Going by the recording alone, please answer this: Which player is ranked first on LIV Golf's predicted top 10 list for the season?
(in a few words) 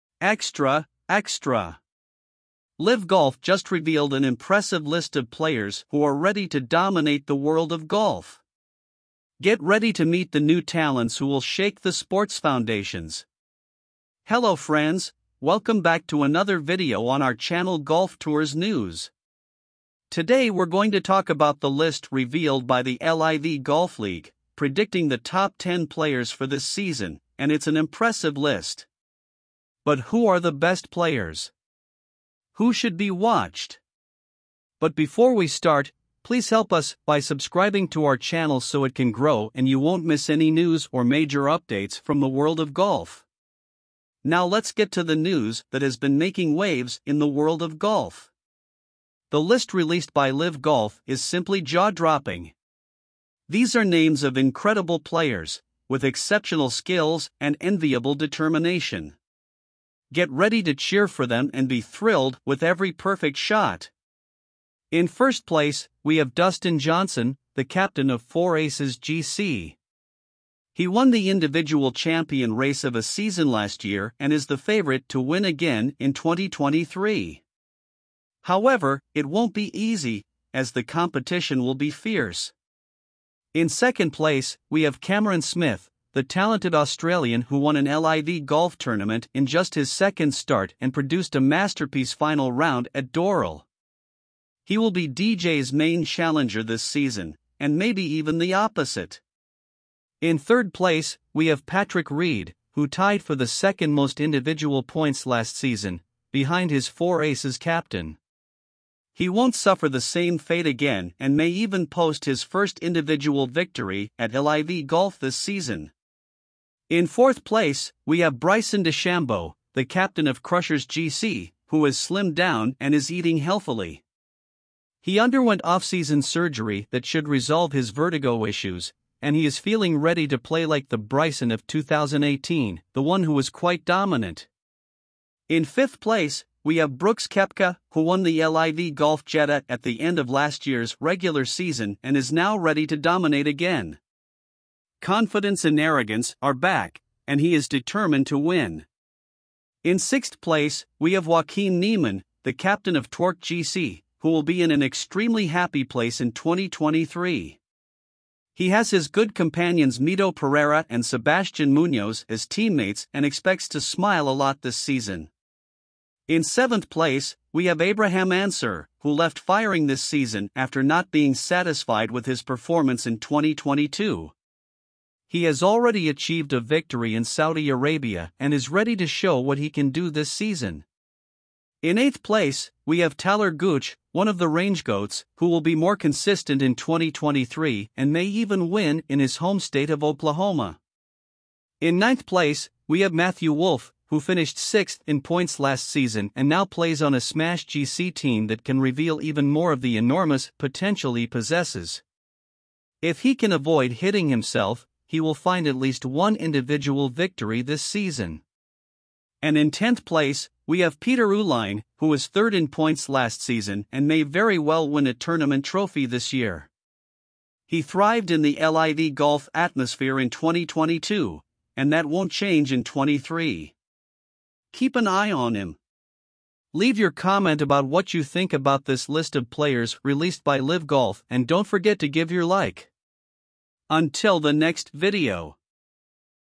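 Dustin Johnson.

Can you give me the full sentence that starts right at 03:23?
If he can avoid hitting himself, he will find at least one individual victory this season.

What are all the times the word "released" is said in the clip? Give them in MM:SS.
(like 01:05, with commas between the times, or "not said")
00:49, 03:50.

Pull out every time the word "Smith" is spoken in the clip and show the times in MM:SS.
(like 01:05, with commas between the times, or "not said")
01:25.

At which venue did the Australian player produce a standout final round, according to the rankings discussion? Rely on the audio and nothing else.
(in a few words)
Doral.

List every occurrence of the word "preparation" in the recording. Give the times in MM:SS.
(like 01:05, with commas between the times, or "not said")
not said.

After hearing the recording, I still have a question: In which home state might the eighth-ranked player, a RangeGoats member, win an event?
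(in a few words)
Oklahoma.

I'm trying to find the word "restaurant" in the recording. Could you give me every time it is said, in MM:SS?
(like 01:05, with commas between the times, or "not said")
not said.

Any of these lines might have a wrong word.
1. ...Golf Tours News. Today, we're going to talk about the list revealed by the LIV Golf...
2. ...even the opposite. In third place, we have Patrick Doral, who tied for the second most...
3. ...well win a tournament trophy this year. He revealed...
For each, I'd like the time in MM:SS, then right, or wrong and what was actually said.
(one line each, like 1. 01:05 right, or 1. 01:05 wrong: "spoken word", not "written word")
1. 00:17 right
2. 01:38 wrong: "Reed", not "Doral"
3. 03:34 wrong: "thrived", not "revealed".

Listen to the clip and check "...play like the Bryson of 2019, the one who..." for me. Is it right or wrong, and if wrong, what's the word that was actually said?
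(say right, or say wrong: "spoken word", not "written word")
wrong: "2018", not "2019".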